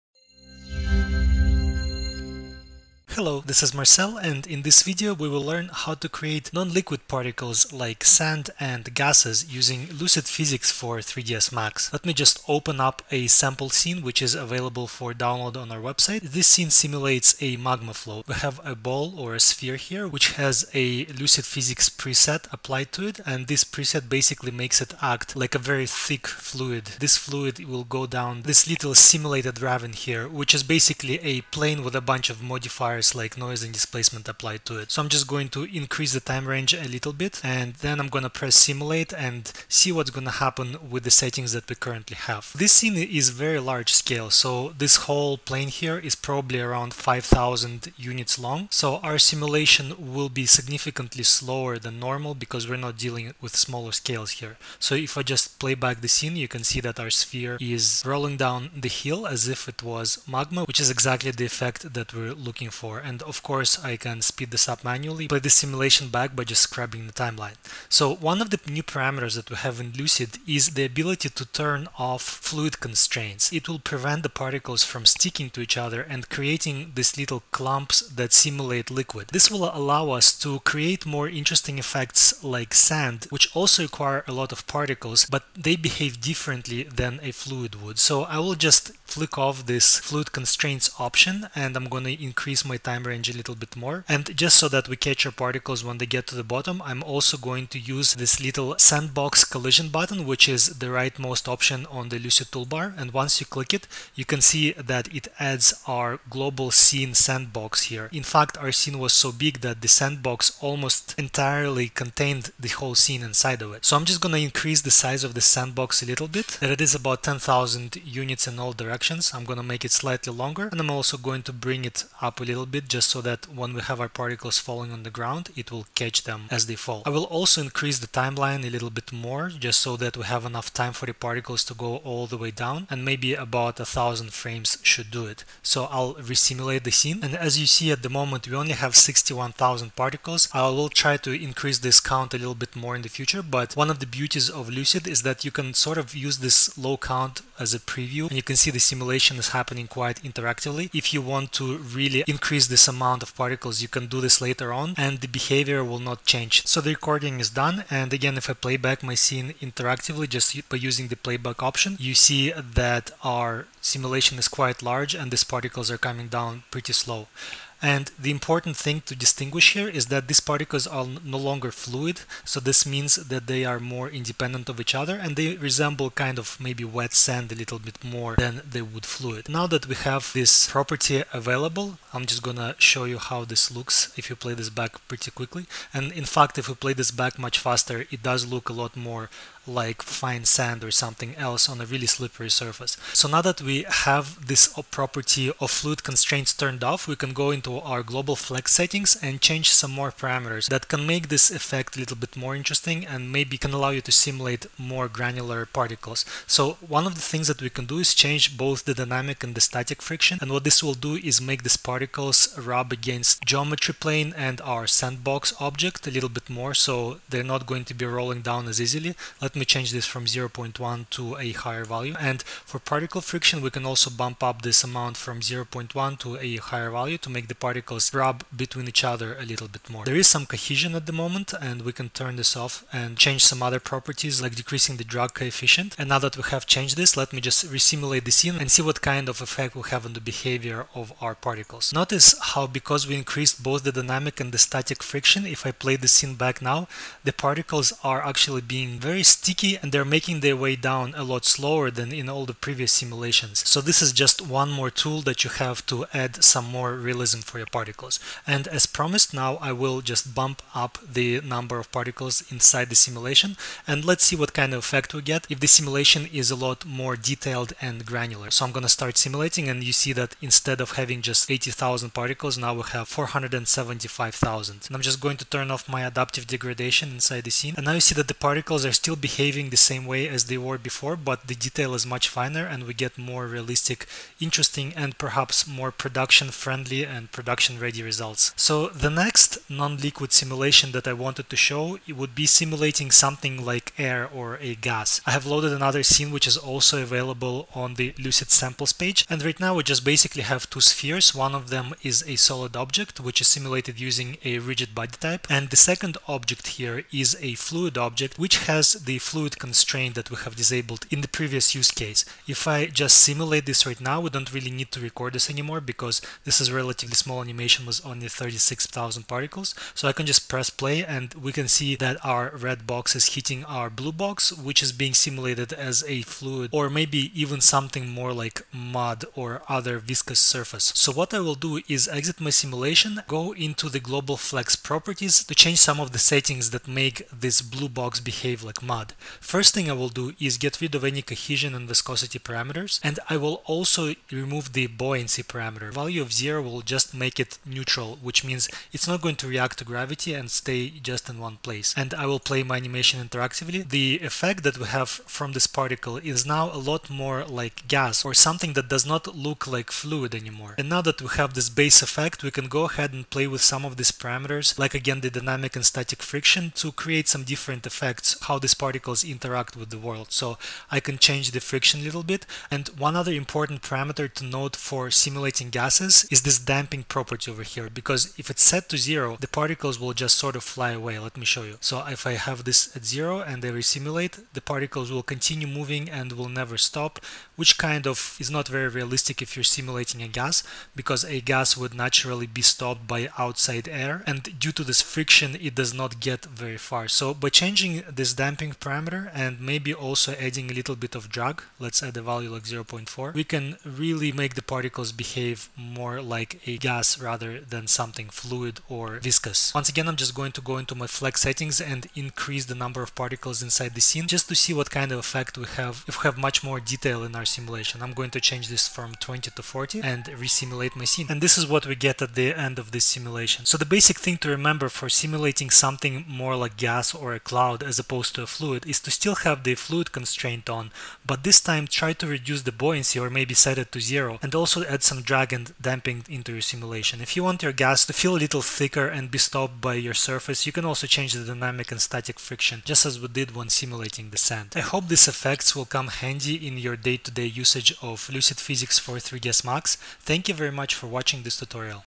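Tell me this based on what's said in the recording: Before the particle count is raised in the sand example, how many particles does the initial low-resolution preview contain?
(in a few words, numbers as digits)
61,000.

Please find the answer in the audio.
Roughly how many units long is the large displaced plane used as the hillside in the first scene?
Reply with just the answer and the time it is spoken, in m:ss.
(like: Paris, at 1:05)
5000, at 0:46.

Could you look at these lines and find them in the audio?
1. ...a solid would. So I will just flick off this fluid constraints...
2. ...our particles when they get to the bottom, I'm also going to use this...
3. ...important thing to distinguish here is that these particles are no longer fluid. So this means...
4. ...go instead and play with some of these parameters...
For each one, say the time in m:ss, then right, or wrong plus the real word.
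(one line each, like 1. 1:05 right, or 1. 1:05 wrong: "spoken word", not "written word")
1. 1:27 wrong: "fluid", not "solid"
2. 1:35 right
3. 2:48 right
4. 6:02 wrong: "ahead", not "instead".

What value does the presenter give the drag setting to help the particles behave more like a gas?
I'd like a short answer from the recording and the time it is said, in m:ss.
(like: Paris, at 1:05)
0.4, at 6:42.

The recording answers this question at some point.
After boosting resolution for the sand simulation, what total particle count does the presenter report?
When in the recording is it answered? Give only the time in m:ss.
4:33.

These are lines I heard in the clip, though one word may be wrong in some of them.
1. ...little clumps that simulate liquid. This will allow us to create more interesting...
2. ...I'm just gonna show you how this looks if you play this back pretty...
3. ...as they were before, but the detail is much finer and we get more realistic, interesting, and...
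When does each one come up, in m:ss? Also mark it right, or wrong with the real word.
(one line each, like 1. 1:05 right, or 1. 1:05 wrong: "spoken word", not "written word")
1. 1:17 right
2. 3:02 right
3. 4:40 right.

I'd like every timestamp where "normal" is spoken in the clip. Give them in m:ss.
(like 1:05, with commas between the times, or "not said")
0:52.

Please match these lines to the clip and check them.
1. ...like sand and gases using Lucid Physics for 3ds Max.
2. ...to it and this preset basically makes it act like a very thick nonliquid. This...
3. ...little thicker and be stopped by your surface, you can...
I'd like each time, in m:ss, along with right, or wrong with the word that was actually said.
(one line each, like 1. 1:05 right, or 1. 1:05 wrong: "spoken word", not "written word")
1. 0:07 right
2. 0:22 wrong: "fluid", not "nonliquid"
3. 7:18 right.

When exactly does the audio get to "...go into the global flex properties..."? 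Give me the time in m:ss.
5:33.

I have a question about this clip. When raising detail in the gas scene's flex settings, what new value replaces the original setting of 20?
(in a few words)
40.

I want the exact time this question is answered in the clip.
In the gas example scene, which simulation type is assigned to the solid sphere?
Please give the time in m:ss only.
5:04.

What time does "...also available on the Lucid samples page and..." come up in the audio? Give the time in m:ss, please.
4:56.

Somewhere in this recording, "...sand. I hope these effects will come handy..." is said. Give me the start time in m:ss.
7:24.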